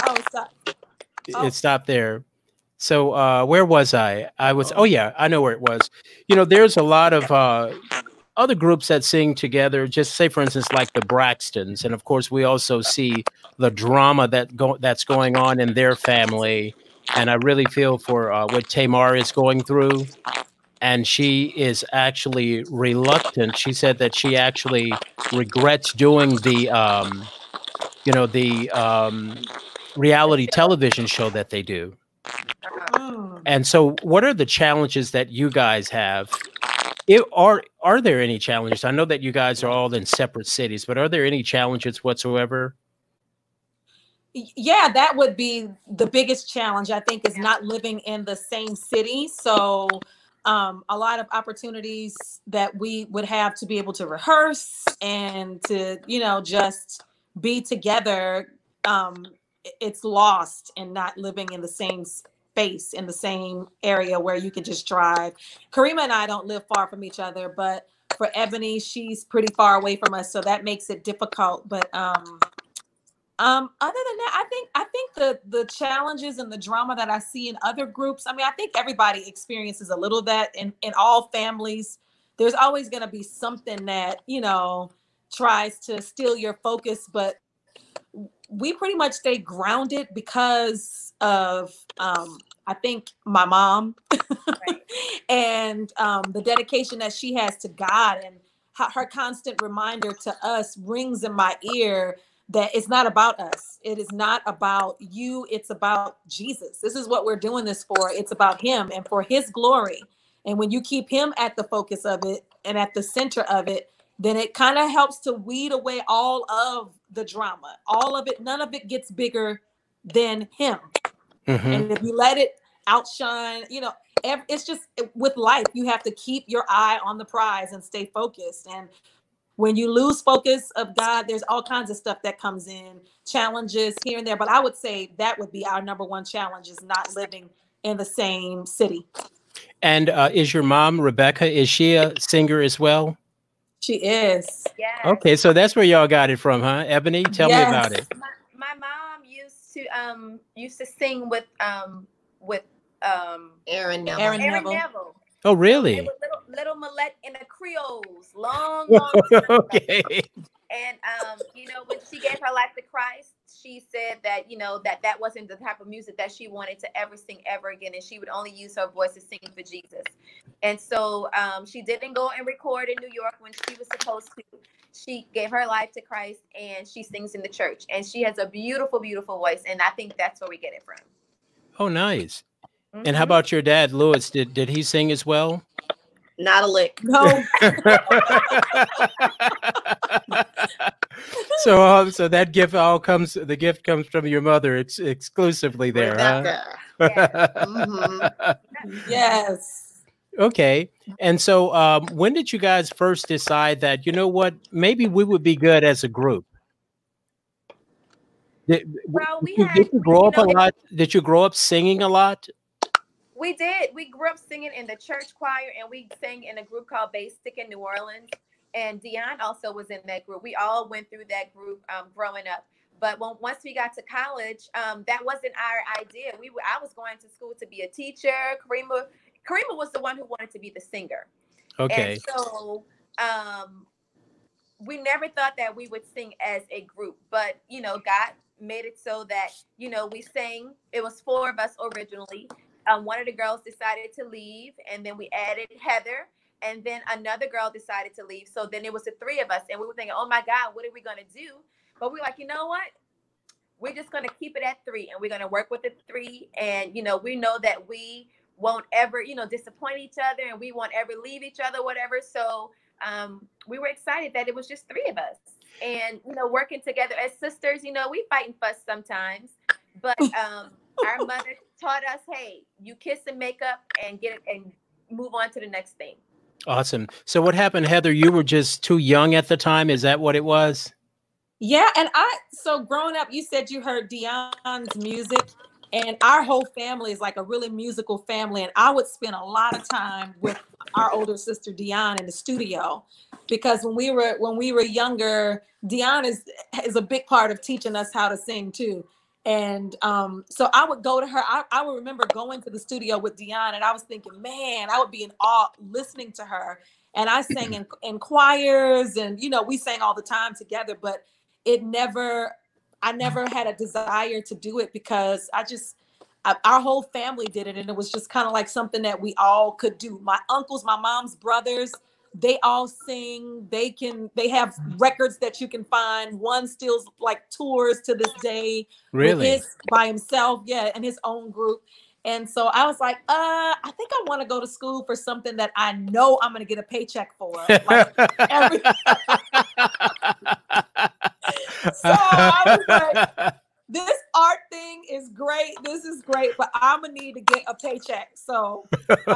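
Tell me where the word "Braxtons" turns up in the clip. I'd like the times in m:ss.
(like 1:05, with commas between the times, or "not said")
0:11.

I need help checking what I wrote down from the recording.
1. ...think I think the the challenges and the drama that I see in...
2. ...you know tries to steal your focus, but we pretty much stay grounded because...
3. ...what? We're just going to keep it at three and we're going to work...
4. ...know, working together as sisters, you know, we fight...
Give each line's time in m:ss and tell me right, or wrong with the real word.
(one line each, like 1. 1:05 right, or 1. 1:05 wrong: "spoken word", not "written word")
1. 1:14 right
2. 1:24 right
3. 4:12 right
4. 4:26 right.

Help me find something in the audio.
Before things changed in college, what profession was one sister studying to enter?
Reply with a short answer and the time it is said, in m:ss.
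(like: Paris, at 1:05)
Teacher, at 3:47.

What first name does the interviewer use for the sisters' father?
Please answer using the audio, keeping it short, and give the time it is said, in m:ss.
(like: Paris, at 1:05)
Lewis, at 3:03.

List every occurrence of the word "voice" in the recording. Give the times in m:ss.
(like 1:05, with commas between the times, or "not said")
2:48, 2:59.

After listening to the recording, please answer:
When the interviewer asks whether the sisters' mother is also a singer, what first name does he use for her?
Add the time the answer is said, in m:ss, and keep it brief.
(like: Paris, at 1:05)
Rebecca, at 2:20.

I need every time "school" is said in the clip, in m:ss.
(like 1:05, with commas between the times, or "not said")
3:47, 5:34.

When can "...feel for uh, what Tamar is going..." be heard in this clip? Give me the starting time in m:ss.
0:17.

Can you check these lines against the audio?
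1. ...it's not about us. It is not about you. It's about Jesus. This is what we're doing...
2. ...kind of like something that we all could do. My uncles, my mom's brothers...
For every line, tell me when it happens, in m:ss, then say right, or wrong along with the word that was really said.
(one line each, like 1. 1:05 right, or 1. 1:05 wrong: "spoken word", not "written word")
1. 1:42 right
2. 5:18 right.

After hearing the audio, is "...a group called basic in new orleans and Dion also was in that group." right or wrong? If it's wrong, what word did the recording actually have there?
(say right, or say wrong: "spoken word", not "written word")
right.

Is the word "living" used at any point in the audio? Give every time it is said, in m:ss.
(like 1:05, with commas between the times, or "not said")
0:47, 1:01, 2:17.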